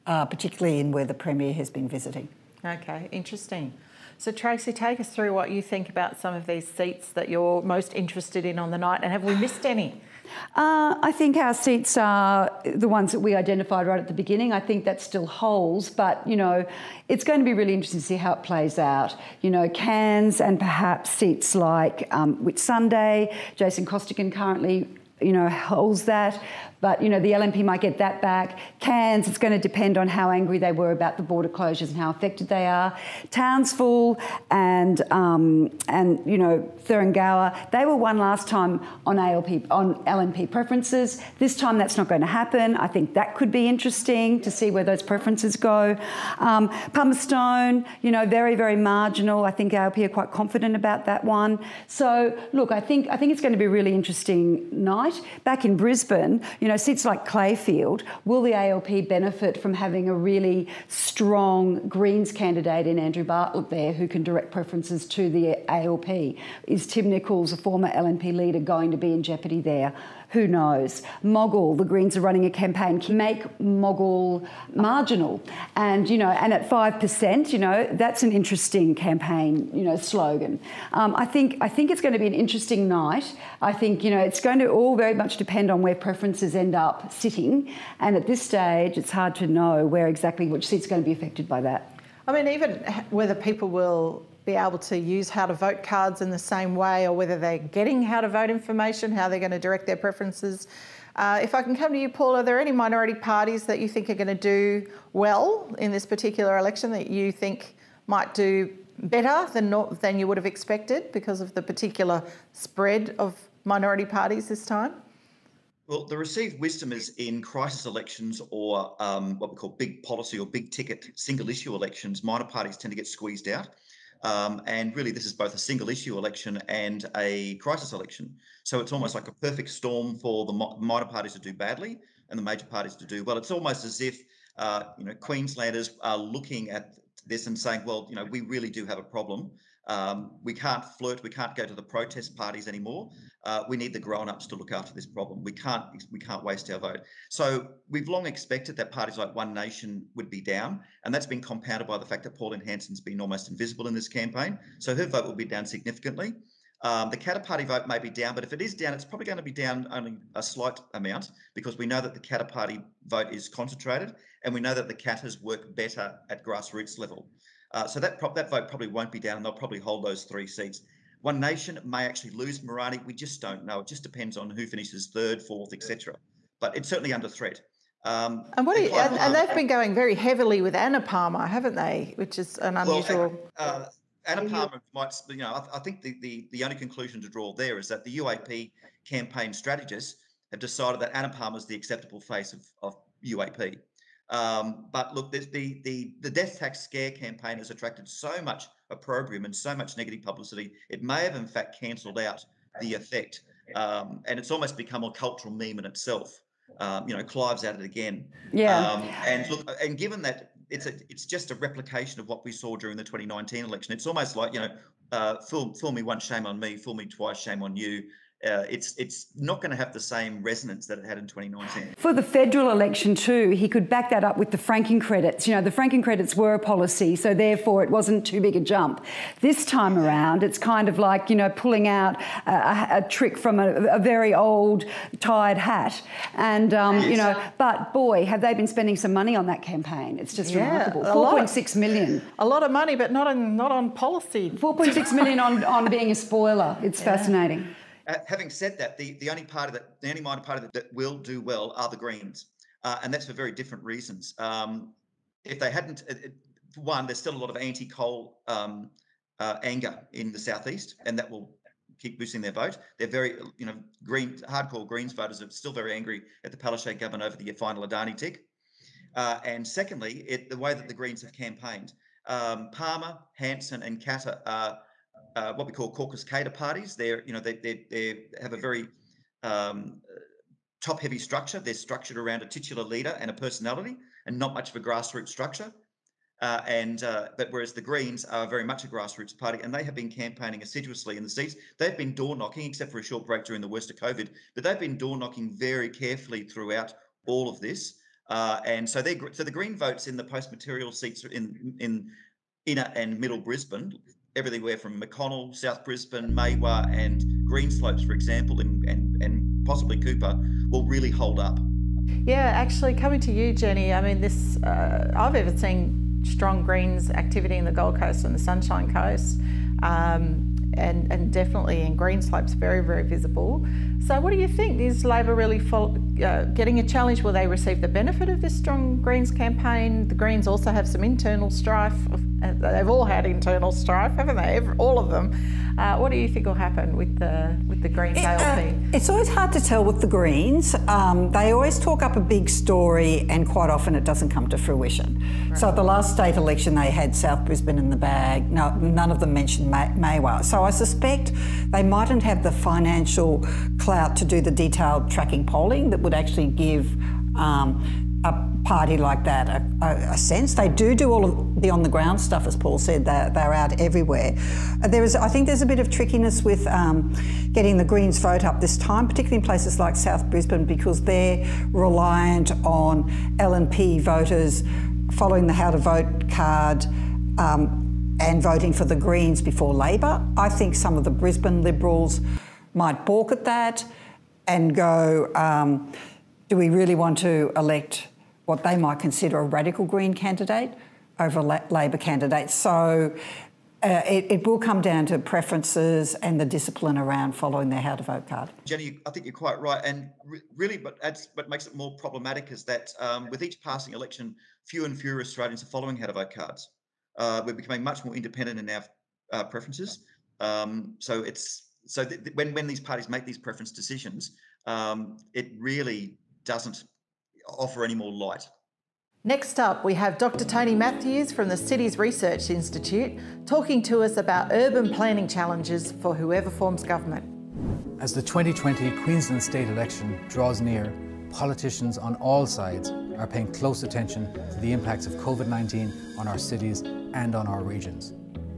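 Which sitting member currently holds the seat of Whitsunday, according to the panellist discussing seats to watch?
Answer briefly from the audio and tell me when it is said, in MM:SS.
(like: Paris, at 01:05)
Jason Costigan, at 00:23.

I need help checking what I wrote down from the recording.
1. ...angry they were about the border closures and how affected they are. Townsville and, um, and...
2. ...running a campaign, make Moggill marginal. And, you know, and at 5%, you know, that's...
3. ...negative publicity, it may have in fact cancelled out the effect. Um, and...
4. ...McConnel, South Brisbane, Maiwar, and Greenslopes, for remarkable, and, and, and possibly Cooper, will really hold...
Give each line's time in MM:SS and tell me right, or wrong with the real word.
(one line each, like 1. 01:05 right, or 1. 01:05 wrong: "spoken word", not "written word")
1. 00:30 right
2. 01:12 right
3. 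03:19 right
4. 05:04 wrong: "example", not "remarkable".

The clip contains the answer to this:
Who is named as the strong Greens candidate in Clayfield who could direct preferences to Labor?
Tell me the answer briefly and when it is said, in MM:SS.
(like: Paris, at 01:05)
Andrew Bartlett, at 01:02.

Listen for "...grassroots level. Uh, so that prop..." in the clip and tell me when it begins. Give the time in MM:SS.
02:46.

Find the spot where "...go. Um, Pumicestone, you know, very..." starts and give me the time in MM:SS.
00:45.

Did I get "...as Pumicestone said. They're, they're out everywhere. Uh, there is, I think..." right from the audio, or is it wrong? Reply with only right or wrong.
wrong.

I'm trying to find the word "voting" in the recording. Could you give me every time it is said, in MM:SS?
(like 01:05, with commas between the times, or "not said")
06:18.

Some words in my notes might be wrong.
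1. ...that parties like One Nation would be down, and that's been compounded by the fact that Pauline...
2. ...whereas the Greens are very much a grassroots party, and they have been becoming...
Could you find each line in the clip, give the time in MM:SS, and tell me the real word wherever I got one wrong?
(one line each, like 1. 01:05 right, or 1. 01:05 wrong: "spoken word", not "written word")
1. 02:28 right
2. 04:47 wrong: "campaigning", not "becoming".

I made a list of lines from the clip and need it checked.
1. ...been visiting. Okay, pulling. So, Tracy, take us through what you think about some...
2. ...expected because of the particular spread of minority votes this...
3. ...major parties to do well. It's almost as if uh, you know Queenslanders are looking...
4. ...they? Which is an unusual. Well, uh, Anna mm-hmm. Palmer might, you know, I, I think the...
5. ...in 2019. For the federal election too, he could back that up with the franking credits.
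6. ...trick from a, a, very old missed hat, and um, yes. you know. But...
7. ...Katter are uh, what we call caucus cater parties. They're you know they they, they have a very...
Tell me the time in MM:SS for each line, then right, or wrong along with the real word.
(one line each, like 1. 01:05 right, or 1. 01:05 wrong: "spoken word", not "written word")
1. 00:01 wrong: "interesting", not "pulling"
2. 01:50 wrong: "parties", not "votes"
3. 02:12 right
4. 03:01 right
5. 03:41 right
6. 03:53 wrong: "tired", not "missed"
7. 04:33 right.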